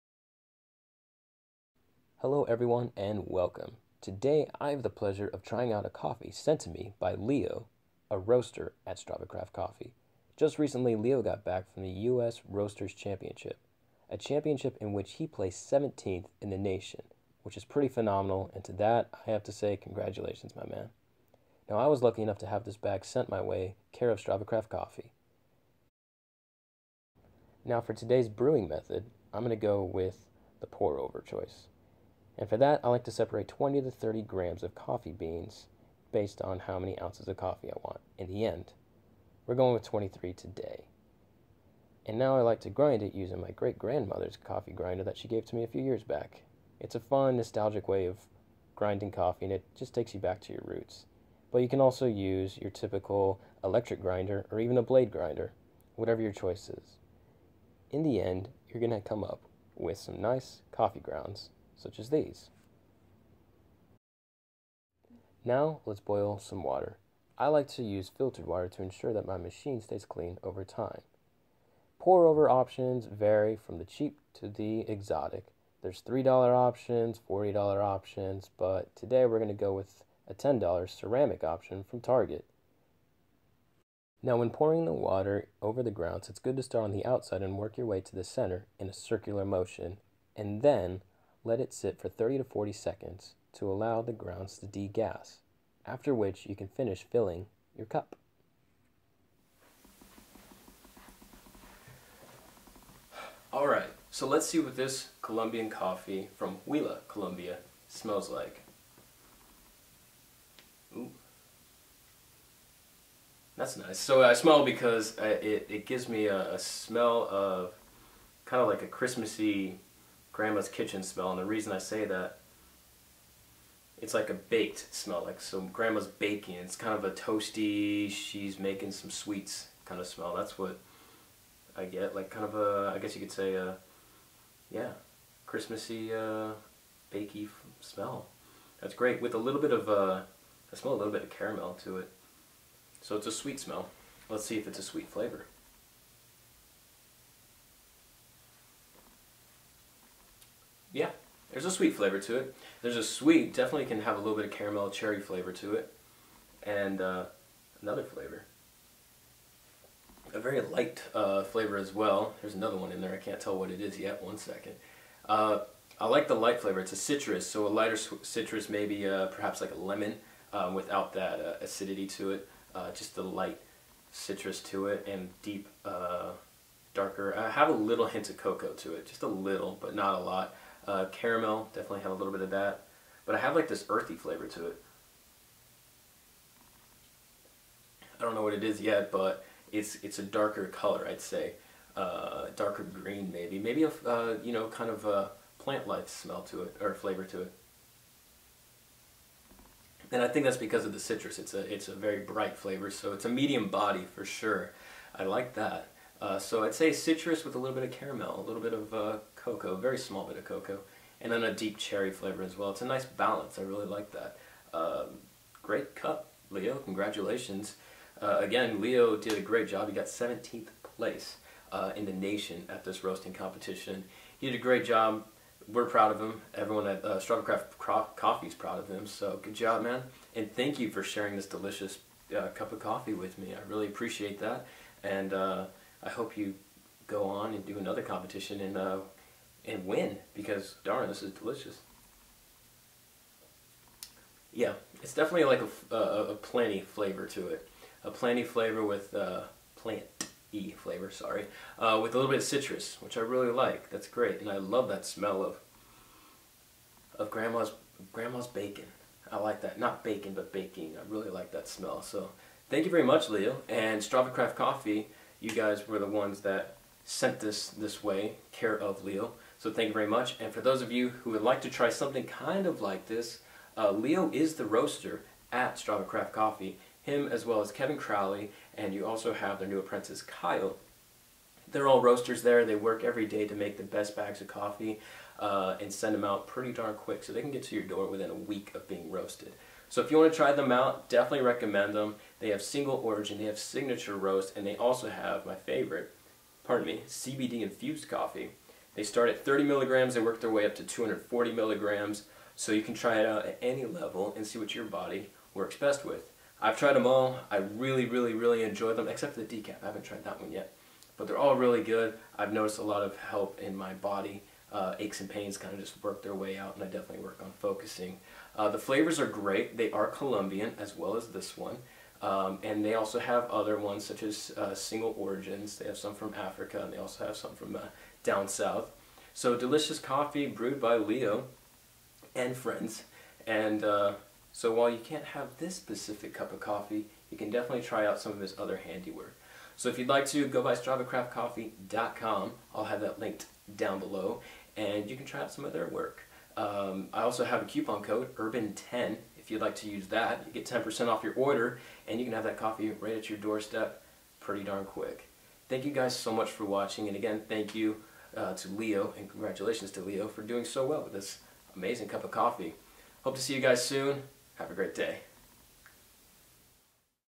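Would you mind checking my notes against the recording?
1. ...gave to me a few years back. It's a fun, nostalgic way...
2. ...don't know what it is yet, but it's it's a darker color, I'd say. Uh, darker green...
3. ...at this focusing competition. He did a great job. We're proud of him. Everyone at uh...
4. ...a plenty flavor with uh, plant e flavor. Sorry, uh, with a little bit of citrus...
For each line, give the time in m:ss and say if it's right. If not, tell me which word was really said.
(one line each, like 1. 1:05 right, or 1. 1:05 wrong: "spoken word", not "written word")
1. 0:45 right
2. 3:08 right
3. 3:42 wrong: "roasting", not "focusing"
4. 4:08 right.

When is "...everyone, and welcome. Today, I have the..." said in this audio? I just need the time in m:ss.
0:02.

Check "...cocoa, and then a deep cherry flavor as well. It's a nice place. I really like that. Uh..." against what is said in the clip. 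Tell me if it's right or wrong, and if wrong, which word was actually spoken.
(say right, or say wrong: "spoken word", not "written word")
wrong: "balance", not "place".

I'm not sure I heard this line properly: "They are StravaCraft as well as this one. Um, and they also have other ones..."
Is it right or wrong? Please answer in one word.
wrong.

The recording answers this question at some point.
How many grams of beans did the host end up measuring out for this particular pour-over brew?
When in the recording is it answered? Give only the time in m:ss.
0:39.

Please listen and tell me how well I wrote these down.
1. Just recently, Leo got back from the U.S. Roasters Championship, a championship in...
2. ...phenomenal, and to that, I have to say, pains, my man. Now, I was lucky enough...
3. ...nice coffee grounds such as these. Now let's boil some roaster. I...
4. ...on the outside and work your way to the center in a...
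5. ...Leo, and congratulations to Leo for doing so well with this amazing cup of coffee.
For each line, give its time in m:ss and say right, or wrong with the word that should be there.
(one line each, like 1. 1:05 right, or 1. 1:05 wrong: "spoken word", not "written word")
1. 0:10 right
2. 0:17 wrong: "congratulations", not "pains"
3. 1:00 wrong: "water", not "roaster"
4. 1:26 right
5. 5:58 right.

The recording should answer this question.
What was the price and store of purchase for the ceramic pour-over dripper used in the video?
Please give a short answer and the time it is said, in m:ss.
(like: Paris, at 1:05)
$10, Target, at 1:20.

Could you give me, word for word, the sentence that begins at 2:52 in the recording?
Uh, just the light citrus to it and deep, darker.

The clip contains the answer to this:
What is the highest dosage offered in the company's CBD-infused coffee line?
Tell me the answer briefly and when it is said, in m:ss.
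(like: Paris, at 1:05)
240 milligrams, at 5:00.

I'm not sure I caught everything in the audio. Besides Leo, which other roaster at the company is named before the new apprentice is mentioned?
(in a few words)
Kevin Crowley.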